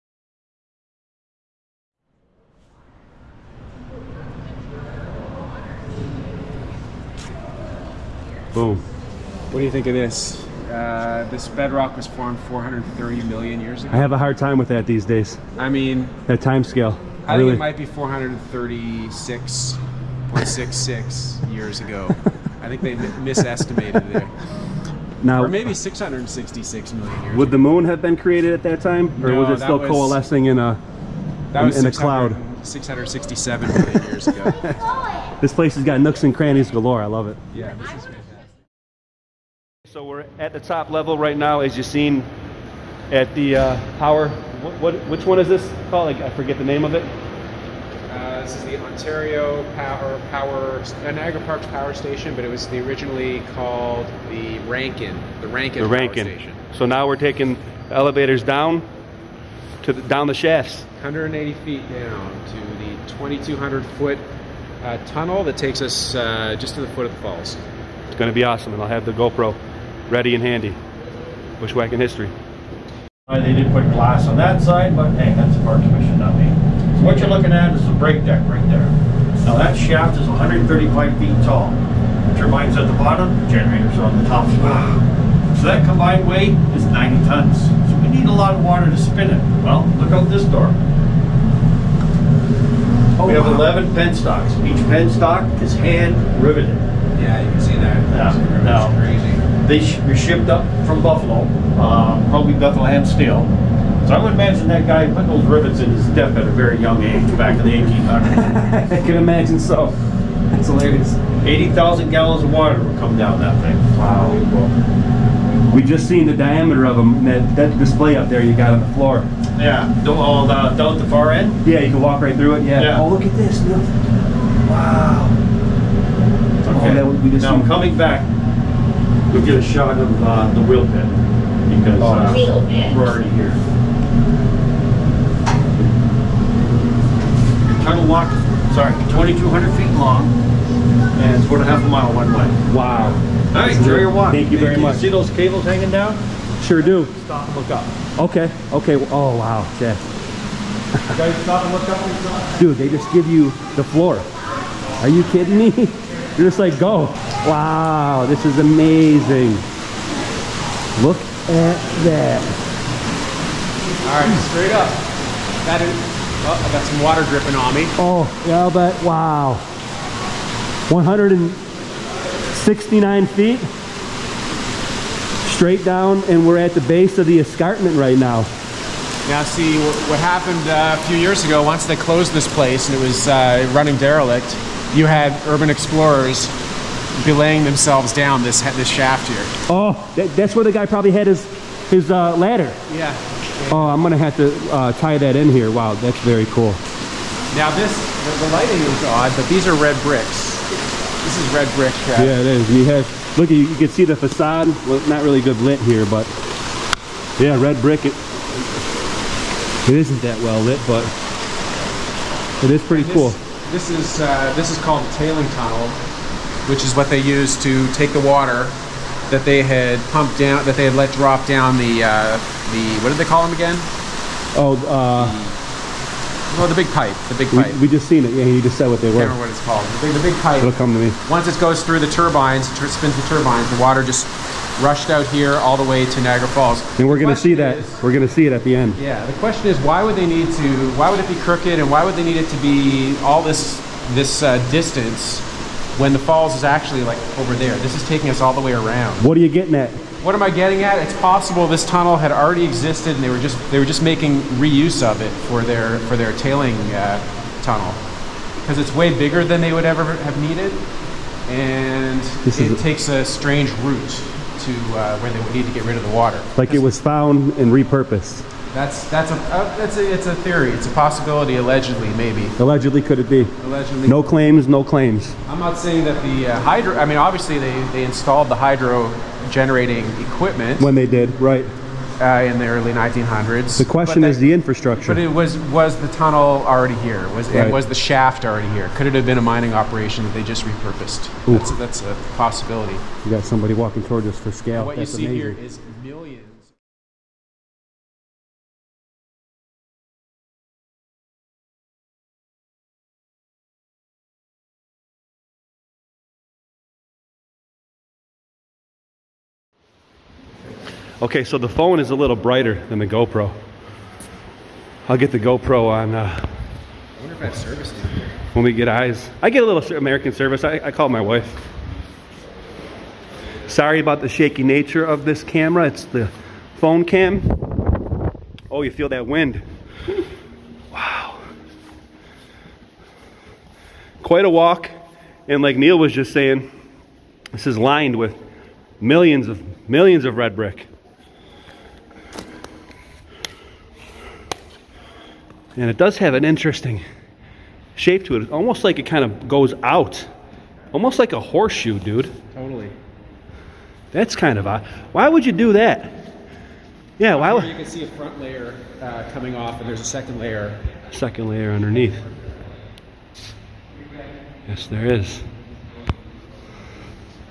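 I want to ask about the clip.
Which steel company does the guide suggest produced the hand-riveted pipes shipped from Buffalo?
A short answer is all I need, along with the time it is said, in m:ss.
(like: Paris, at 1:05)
Bethlehem Steel, at 1:42.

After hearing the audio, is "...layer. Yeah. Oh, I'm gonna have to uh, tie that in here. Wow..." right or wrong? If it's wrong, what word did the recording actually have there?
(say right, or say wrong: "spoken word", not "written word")
wrong: "ladder", not "layer".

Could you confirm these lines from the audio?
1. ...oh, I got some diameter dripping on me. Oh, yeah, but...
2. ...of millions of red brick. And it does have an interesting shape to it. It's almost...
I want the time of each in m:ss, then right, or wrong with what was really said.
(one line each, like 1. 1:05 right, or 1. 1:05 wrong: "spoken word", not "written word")
1. 2:46 wrong: "water", not "diameter"
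2. 5:39 right.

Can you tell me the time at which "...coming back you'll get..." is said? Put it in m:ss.
2:07.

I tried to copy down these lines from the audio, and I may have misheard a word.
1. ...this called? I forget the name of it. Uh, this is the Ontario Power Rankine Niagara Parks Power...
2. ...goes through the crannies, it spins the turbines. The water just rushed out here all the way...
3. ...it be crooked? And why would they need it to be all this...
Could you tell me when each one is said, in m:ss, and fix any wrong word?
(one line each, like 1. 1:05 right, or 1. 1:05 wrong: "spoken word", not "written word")
1. 0:45 wrong: "Power", not "Rankine"
2. 3:51 wrong: "turbines", not "crannies"
3. 4:01 right.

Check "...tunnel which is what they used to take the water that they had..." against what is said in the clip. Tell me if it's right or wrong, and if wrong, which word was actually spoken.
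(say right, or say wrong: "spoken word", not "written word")
right.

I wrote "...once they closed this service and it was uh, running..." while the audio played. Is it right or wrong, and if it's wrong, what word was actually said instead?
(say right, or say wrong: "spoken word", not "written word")
wrong: "place", not "service".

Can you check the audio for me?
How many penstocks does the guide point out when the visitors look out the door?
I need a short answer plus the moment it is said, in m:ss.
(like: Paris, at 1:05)
11, at 1:33.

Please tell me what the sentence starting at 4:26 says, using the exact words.
Like it was found and repurposed.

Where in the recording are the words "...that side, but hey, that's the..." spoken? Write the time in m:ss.
1:14.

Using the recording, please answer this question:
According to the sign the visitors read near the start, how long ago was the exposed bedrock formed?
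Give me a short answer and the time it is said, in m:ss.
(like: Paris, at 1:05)
430 million years ago, at 0:12.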